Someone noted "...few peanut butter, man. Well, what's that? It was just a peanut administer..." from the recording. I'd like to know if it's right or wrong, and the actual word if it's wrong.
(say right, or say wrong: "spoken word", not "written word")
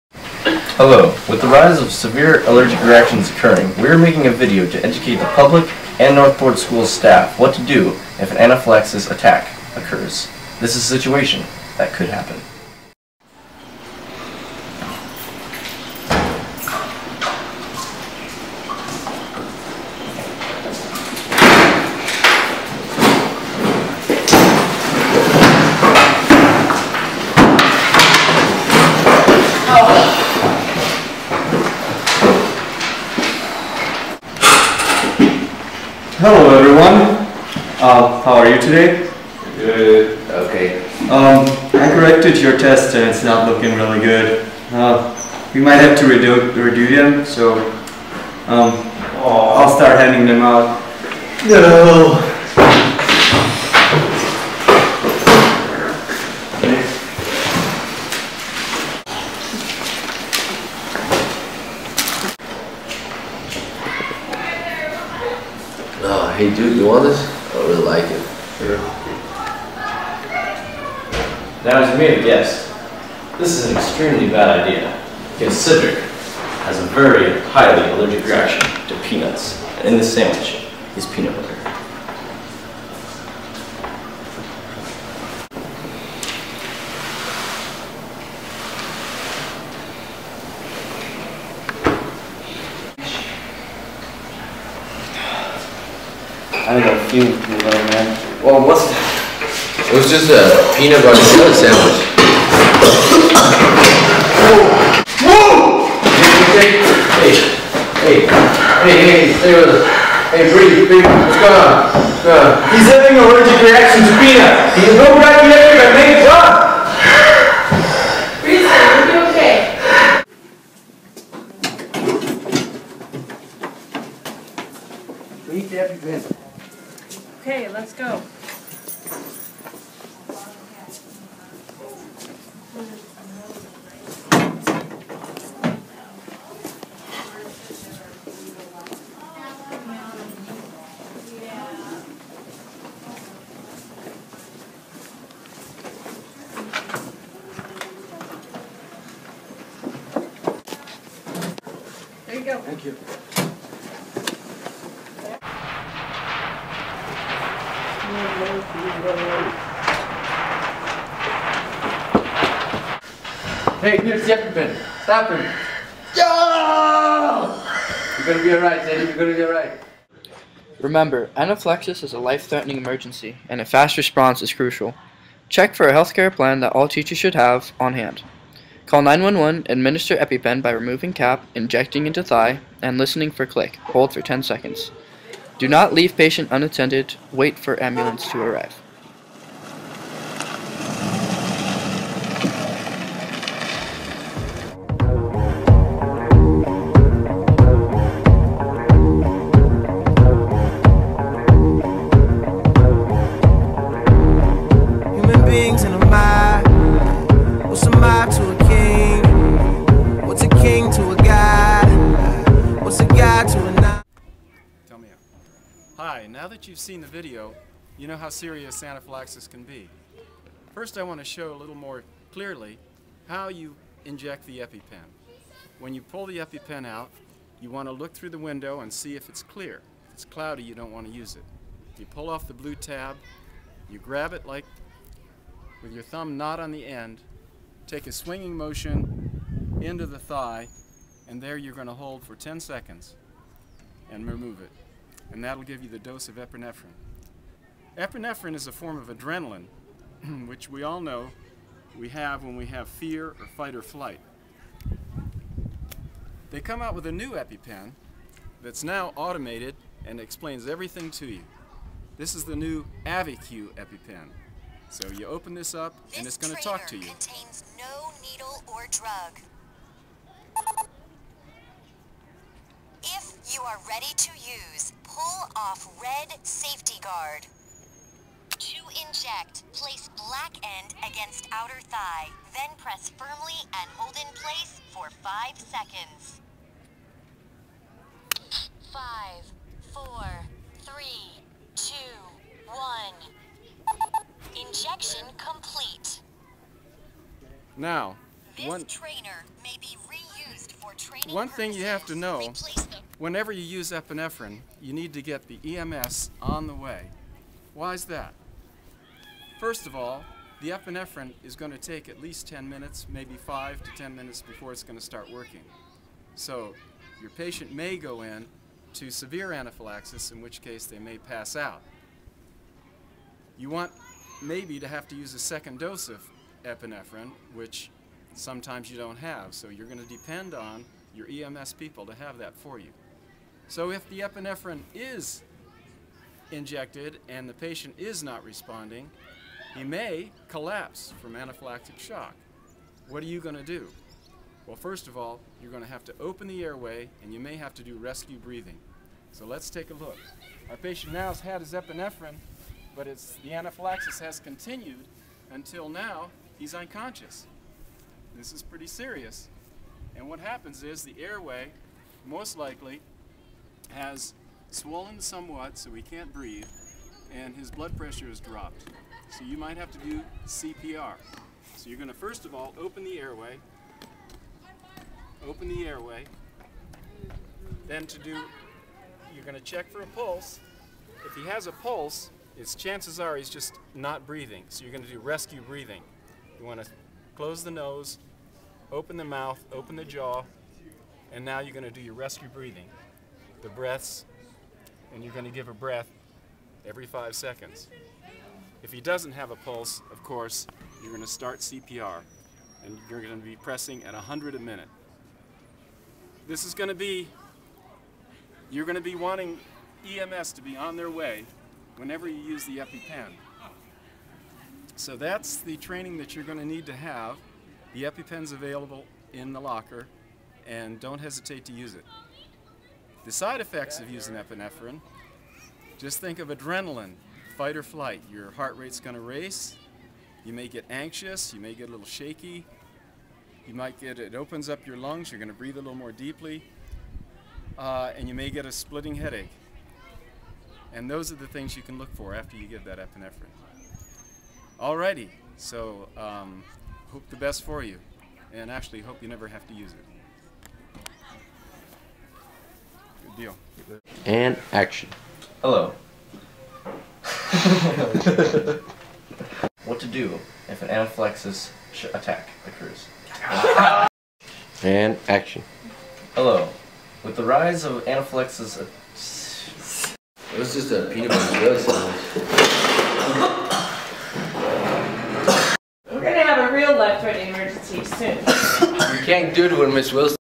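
wrong: "butter", not "administer".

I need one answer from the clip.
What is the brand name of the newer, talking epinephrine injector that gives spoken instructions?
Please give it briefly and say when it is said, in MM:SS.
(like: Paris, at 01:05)
AviQ, at 04:23.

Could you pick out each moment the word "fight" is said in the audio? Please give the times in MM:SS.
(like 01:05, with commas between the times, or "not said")
04:13, 07:07.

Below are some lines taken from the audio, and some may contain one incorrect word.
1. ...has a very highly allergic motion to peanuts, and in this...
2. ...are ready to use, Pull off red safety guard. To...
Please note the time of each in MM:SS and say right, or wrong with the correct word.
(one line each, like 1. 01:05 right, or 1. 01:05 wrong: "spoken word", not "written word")
1. 01:16 wrong: "reaction", not "motion"
2. 04:33 right.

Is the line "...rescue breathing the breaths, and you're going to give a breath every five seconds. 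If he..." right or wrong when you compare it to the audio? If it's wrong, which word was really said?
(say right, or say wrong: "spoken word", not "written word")
right.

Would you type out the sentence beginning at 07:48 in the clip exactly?
Uh, it was just a peanut butter jelly We're gonna have a real life-threatening emergency soon.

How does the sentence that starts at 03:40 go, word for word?
First I want to show a little more clearly how you inject the EpiPen.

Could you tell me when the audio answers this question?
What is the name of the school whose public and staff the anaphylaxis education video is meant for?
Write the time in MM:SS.
00:06.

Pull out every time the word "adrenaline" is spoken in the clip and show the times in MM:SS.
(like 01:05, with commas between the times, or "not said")
04:09, 07:06.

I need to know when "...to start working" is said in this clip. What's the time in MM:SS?
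05:14.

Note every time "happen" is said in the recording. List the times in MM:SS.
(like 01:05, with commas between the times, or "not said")
00:12, 06:00.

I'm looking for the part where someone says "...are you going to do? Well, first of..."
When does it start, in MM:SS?
05:43.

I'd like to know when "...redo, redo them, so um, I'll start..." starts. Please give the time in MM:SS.
00:46.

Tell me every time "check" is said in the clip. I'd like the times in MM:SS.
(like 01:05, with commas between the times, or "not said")
02:55, 06:19.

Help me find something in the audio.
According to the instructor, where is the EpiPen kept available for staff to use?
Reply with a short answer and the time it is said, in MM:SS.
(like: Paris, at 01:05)
In the locker, at 06:59.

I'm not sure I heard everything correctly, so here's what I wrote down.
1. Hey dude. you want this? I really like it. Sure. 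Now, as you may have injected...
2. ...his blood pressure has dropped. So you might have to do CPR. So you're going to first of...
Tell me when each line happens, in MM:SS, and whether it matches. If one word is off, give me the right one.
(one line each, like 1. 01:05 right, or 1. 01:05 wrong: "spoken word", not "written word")
1. 01:06 wrong: "guessed", not "injected"
2. 06:07 right.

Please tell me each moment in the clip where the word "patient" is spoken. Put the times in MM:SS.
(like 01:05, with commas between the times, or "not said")
03:06, 05:17, 05:37, 05:50.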